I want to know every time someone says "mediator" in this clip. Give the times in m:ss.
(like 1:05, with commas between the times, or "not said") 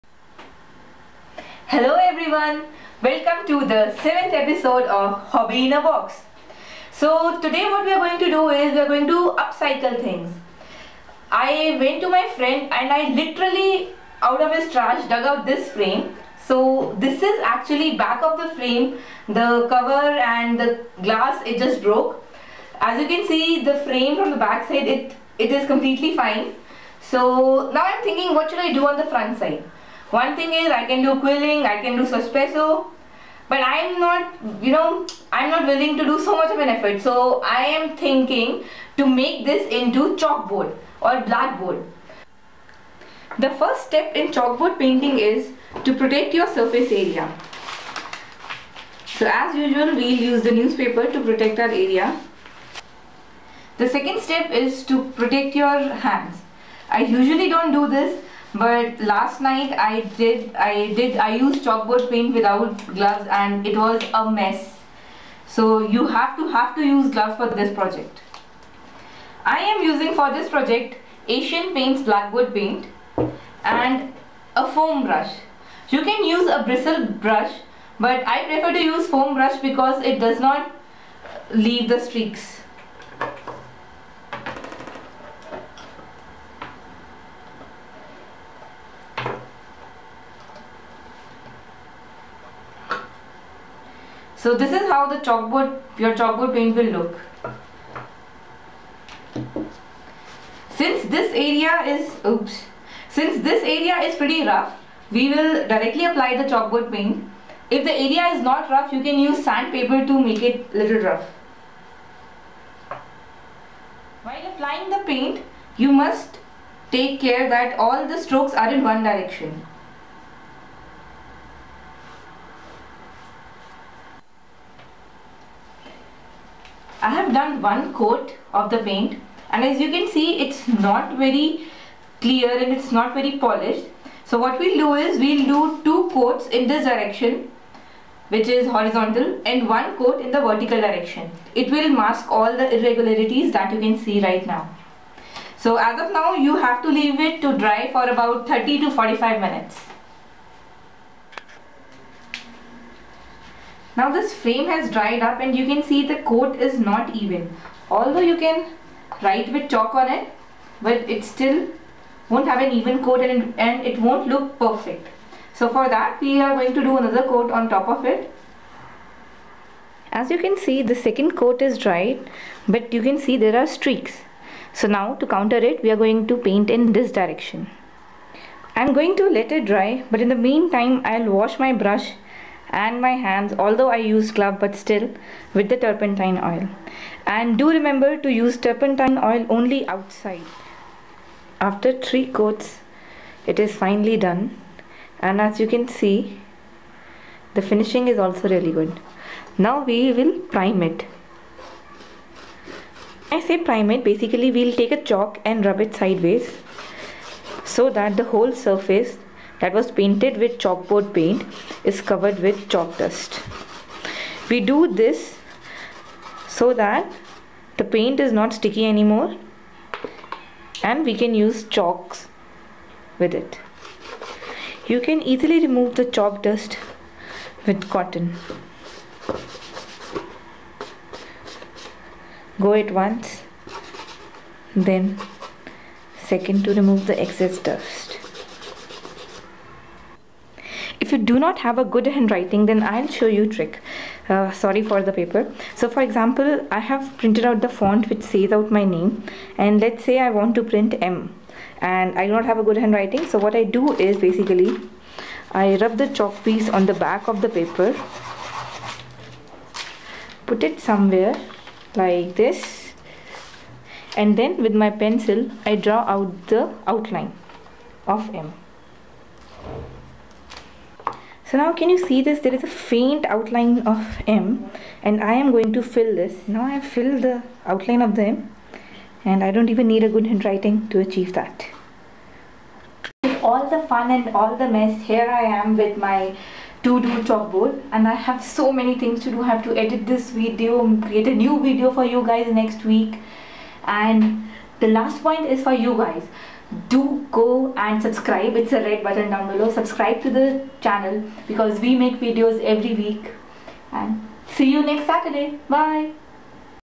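not said.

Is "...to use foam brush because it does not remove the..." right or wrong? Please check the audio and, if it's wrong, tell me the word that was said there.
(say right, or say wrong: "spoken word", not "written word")
wrong: "leave", not "remove".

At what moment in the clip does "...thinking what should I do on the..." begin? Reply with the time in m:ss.
0:28.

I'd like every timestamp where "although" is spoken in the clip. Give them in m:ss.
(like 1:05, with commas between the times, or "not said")
2:37, 3:03.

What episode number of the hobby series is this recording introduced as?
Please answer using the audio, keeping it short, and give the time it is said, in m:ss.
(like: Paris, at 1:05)
7th, at 0:03.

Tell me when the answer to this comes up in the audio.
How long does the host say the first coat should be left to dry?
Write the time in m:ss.
2:28.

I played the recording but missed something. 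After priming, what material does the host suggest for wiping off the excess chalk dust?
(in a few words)
Cotton.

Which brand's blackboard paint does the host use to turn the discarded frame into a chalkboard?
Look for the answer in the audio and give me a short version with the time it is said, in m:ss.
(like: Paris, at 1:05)
Asian Paints, at 1:11.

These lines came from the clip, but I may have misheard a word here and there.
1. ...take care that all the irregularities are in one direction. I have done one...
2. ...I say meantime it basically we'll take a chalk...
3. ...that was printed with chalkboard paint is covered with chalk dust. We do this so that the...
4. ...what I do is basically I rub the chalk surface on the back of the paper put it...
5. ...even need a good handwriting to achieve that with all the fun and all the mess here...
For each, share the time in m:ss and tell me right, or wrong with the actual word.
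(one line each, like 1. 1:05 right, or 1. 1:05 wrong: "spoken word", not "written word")
1. 1:56 wrong: "strokes", not "irregularities"
2. 3:23 wrong: "prime", not "meantime"
3. 3:29 wrong: "painted", not "printed"
4. 4:13 wrong: "piece", not "surface"
5. 4:39 right.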